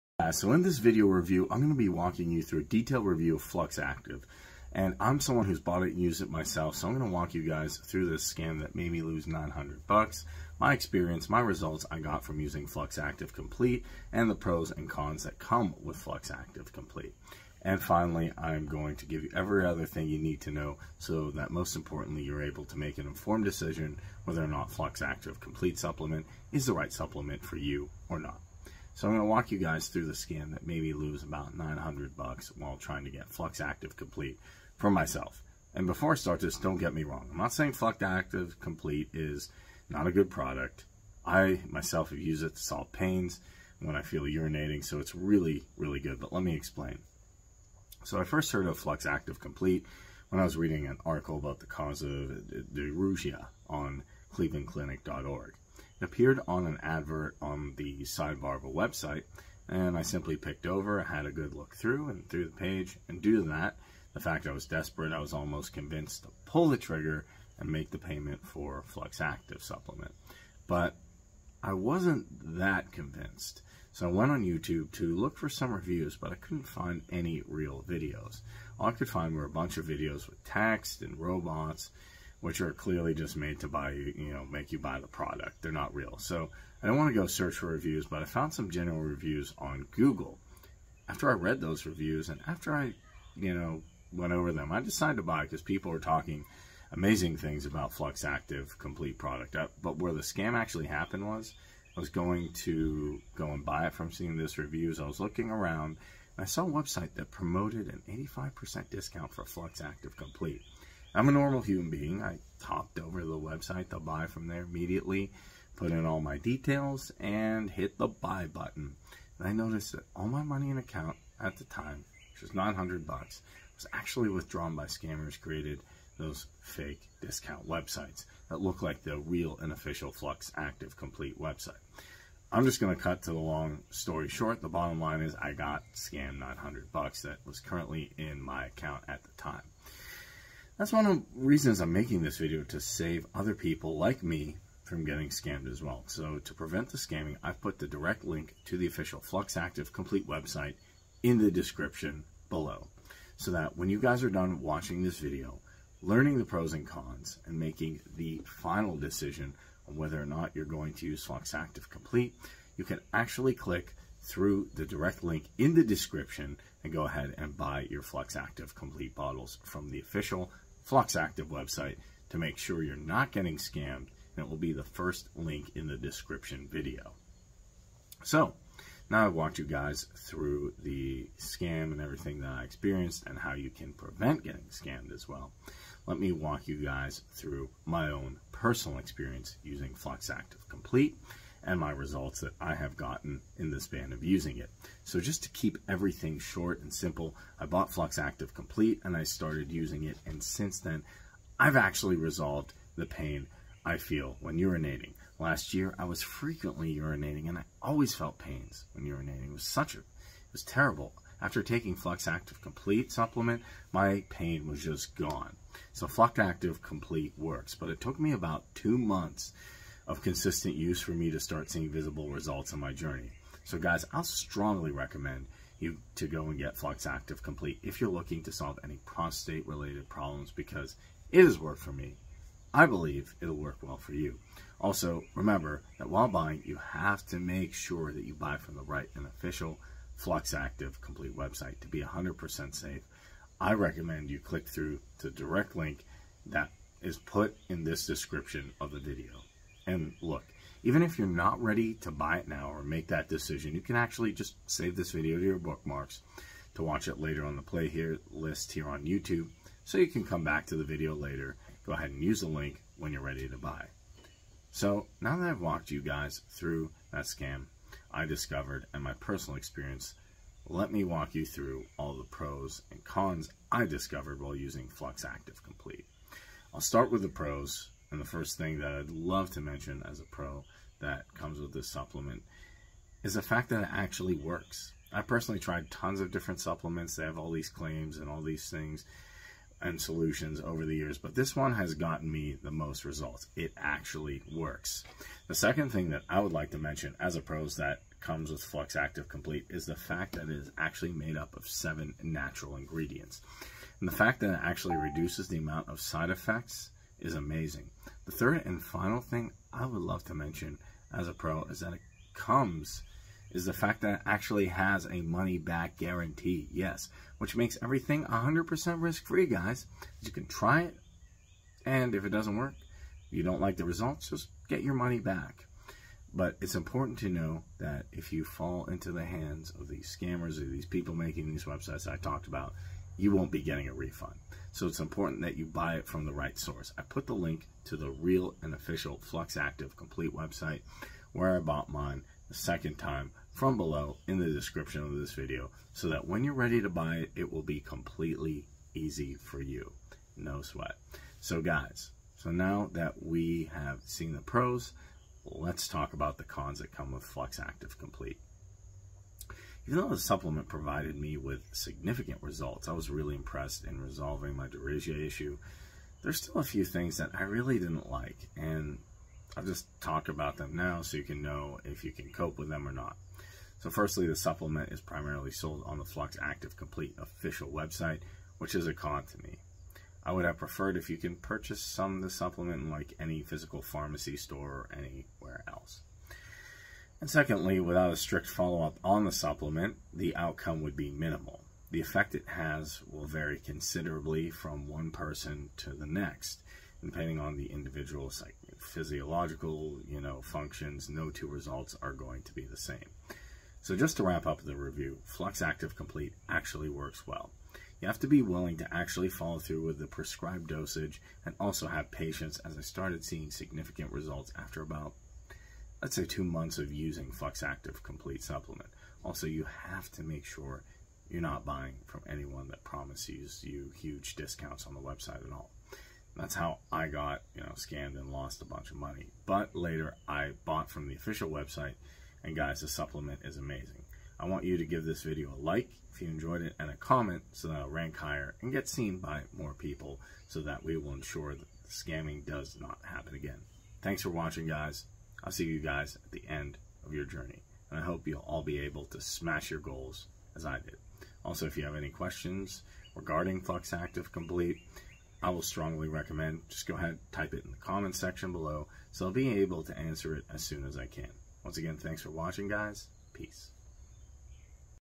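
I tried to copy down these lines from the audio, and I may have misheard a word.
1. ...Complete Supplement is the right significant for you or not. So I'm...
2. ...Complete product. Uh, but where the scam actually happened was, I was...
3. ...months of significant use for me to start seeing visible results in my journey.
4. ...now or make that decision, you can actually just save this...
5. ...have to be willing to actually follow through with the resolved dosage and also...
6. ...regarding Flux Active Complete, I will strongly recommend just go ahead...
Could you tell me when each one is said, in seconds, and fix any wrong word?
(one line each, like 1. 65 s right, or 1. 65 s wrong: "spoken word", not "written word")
1. 25 s wrong: "supplement", not "significant"
2. 98 s right
3. 218 s wrong: "consistent", not "significant"
4. 252 s right
5. 408 s wrong: "prescribed", not "resolved"
6. 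453 s right.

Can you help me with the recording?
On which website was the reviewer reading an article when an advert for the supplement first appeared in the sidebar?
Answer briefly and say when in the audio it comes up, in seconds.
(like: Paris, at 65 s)
clevelandclinic.org, at 54 s.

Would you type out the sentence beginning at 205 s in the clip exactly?
Last year, I was frequently urinating and I always felt pains when urinating.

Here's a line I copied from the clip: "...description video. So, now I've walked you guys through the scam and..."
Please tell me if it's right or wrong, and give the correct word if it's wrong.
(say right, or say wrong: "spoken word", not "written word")
right.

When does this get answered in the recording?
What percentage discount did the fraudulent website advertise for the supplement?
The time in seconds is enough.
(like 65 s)
108 s.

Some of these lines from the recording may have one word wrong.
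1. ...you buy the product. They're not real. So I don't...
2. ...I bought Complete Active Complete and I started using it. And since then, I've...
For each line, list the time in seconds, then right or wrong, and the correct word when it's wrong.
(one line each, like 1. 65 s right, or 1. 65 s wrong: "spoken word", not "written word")
1. 84 s right
2. 197 s wrong: "Flux", not "Complete".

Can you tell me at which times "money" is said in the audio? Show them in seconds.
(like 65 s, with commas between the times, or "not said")
120 s, 315 s, 324 s, 428 s.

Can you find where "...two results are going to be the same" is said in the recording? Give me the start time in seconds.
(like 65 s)
401 s.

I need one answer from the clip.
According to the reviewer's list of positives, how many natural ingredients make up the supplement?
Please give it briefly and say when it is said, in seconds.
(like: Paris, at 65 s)
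7, at 301 s.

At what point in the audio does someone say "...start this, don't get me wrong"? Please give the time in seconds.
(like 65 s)
36 s.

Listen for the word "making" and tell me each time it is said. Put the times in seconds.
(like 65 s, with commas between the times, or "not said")
141 s, 157 s, 331 s.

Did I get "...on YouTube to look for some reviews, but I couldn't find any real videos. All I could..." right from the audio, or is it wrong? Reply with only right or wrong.
right.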